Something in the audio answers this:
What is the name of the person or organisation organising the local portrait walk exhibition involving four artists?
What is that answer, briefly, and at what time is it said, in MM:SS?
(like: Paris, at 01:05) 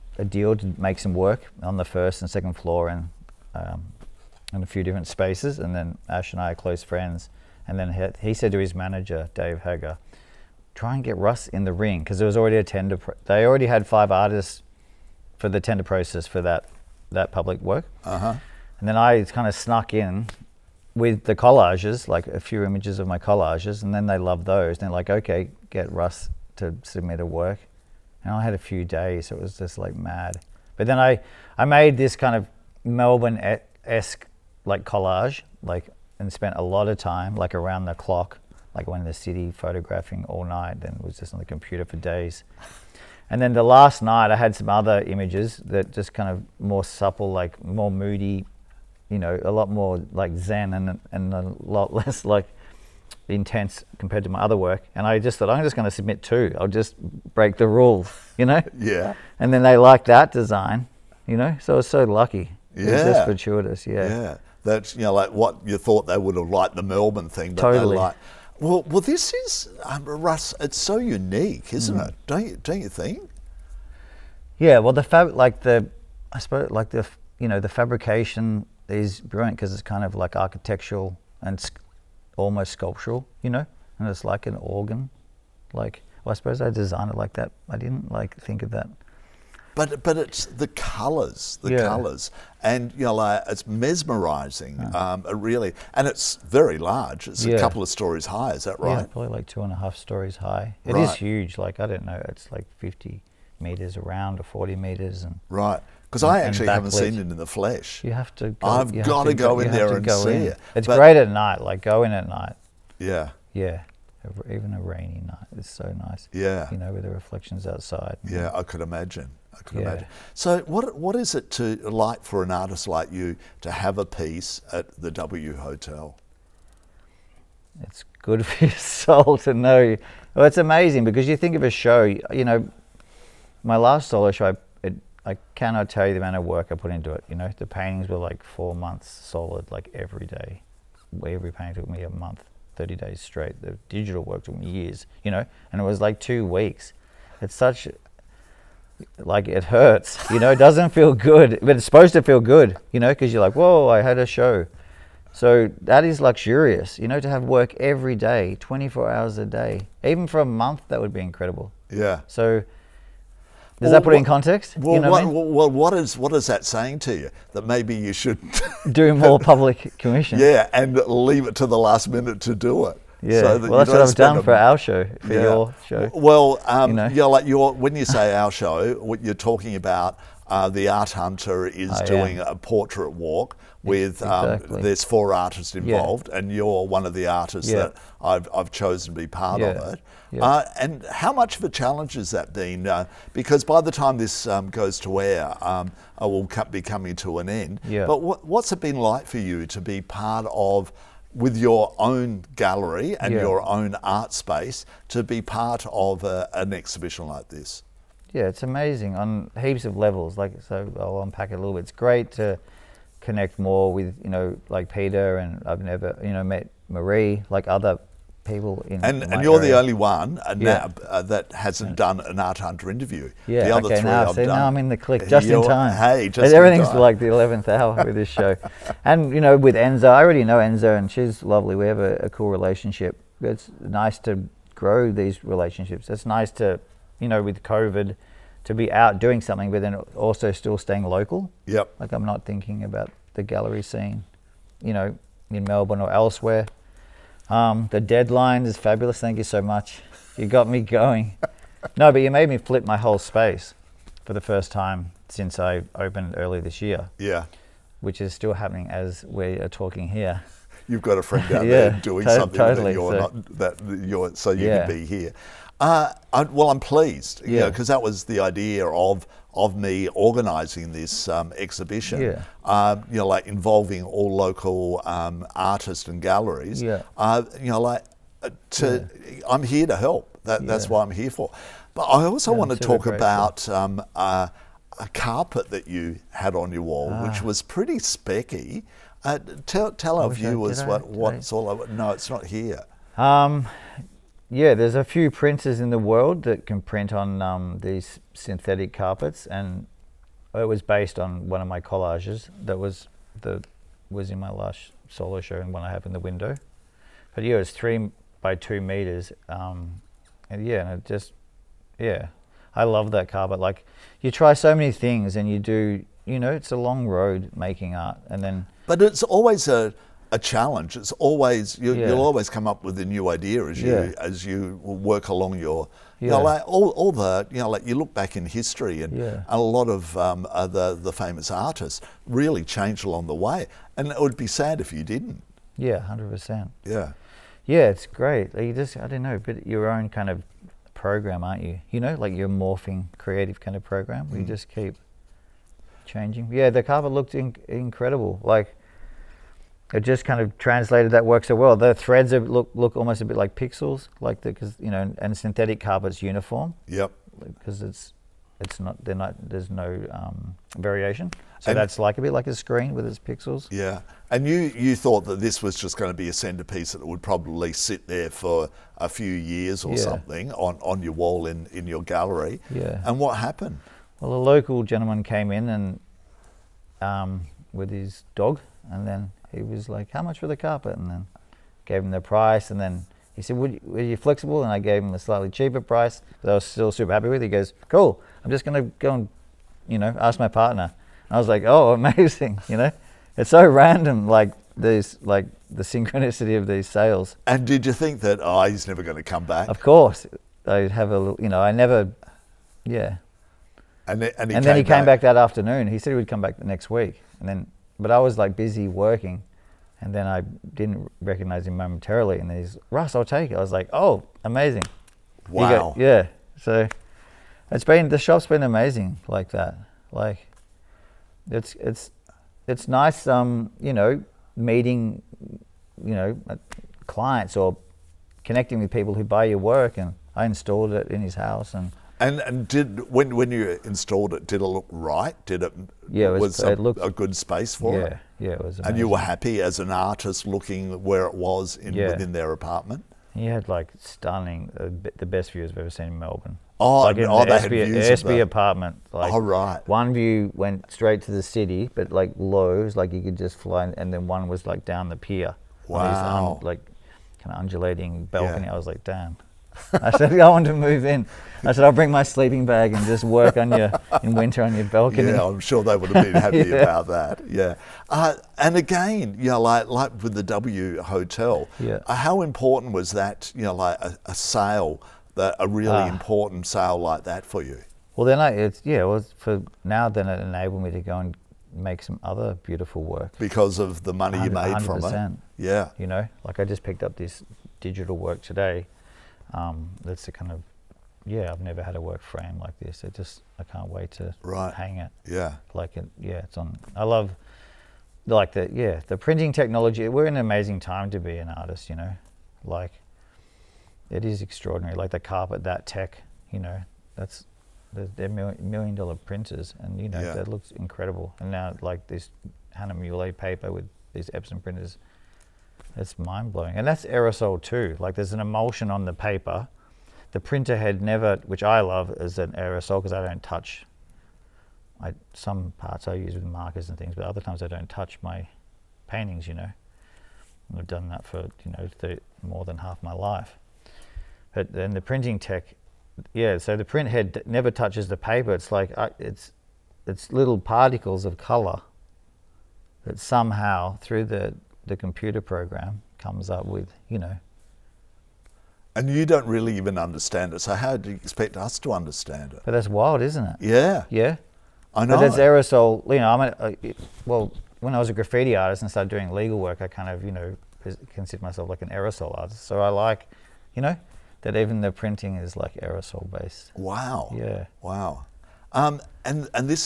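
The Art Hunter, at 03:00.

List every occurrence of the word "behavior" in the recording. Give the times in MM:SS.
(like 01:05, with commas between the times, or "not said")
not said.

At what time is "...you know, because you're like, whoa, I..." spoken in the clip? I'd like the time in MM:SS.
02:32.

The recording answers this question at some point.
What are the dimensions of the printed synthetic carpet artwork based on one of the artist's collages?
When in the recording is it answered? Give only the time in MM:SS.
05:07.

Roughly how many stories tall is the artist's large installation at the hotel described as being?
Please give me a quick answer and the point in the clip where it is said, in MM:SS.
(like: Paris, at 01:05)
2.5, at 01:39.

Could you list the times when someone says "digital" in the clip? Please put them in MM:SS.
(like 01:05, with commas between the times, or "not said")
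02:23, 08:07.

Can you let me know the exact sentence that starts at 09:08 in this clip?
And you don't really even understand it, so how do you expect us to understand it?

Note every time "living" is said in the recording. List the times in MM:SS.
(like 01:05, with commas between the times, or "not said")
not said.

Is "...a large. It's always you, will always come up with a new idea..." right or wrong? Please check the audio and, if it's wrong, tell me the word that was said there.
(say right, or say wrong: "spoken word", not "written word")
wrong: "challenge", not "large".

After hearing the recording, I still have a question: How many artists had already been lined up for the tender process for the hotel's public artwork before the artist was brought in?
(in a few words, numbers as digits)
5.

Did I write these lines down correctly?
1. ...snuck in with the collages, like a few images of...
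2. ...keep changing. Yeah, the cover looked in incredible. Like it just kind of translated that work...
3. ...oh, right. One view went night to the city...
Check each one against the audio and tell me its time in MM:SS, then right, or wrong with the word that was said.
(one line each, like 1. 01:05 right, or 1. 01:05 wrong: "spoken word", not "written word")
1. 00:19 right
2. 05:44 right
3. 07:29 wrong: "straight", not "night".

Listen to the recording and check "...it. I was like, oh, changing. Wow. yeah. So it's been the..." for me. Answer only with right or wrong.
wrong.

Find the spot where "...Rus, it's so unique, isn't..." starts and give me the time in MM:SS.
01:10.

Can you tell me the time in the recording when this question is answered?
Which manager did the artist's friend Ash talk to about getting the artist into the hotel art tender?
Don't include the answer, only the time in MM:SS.
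00:09.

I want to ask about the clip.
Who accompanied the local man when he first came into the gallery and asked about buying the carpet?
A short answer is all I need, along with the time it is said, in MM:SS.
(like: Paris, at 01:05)
his dog, at 06:17.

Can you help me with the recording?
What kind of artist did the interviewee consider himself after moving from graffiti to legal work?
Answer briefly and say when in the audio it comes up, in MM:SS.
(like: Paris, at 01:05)
aerosol artist, at 09:21.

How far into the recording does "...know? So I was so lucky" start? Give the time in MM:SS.
01:01.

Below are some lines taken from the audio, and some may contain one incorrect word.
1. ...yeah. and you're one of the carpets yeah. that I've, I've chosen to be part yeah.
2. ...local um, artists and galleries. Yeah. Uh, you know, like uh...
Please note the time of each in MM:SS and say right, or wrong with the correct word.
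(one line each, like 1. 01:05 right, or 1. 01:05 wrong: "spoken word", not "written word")
1. 03:06 wrong: "artists", not "carpets"
2. 04:34 right.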